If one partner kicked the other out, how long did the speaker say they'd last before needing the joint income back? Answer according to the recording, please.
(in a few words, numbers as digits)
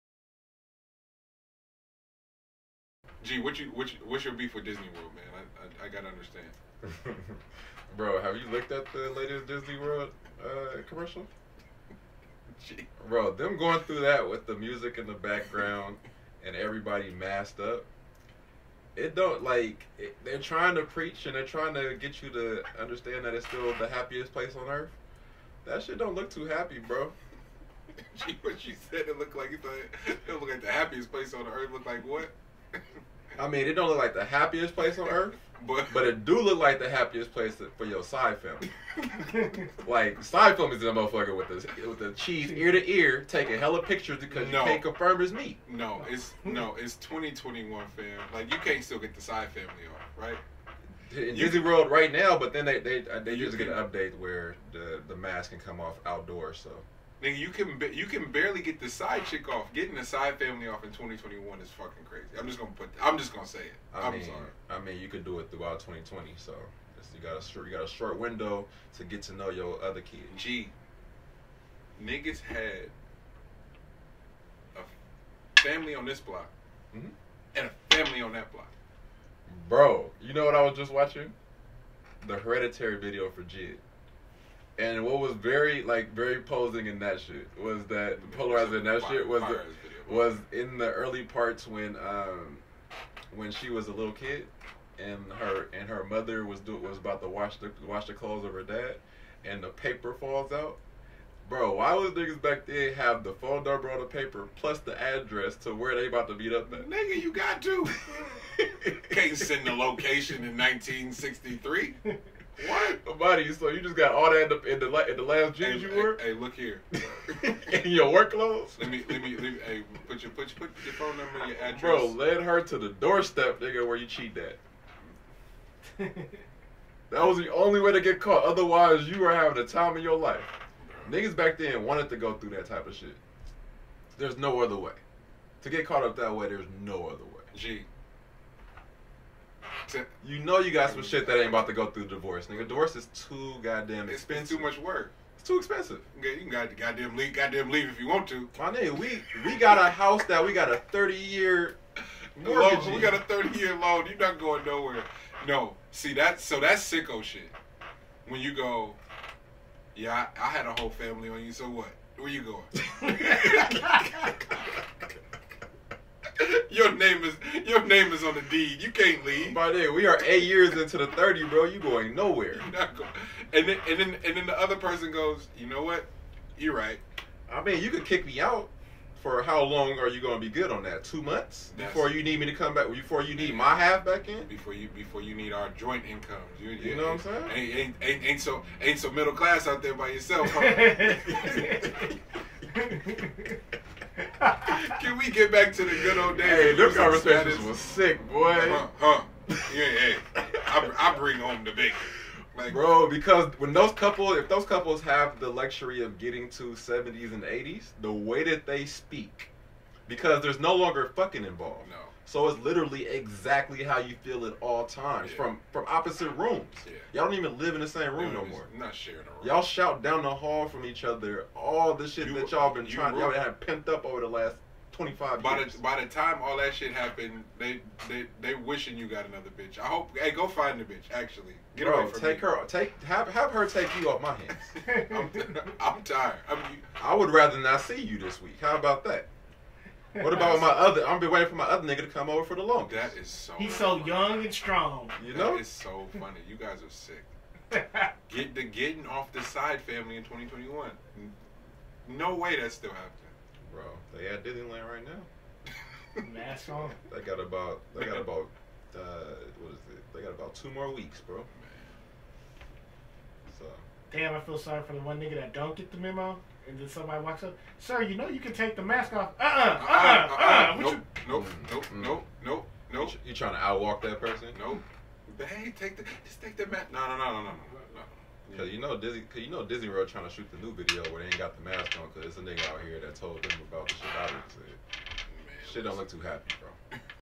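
2 months.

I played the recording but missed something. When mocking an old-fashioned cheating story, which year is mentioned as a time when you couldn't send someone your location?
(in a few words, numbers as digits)
1963.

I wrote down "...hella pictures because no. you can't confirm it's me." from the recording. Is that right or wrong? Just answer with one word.
right.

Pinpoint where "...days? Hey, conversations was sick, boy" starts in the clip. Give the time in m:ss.
3:16.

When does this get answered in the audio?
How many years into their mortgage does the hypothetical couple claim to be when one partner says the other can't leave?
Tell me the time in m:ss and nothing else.
2:50.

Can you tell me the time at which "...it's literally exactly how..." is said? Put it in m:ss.
3:32.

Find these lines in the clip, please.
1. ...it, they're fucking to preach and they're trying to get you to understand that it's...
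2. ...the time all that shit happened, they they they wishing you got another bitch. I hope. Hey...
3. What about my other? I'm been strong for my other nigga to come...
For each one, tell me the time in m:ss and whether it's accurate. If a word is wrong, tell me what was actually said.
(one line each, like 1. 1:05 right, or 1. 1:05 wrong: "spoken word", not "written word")
1. 0:19 wrong: "trying", not "fucking"
2. 3:45 right
3. 4:00 wrong: "waiting", not "strong".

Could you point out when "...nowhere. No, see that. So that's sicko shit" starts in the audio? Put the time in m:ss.
2:34.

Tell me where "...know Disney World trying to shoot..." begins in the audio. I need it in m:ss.
4:39.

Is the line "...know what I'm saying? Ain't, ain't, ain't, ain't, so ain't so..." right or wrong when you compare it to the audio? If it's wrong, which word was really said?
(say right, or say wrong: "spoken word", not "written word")
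right.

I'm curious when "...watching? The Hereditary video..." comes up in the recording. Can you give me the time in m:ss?
1:20.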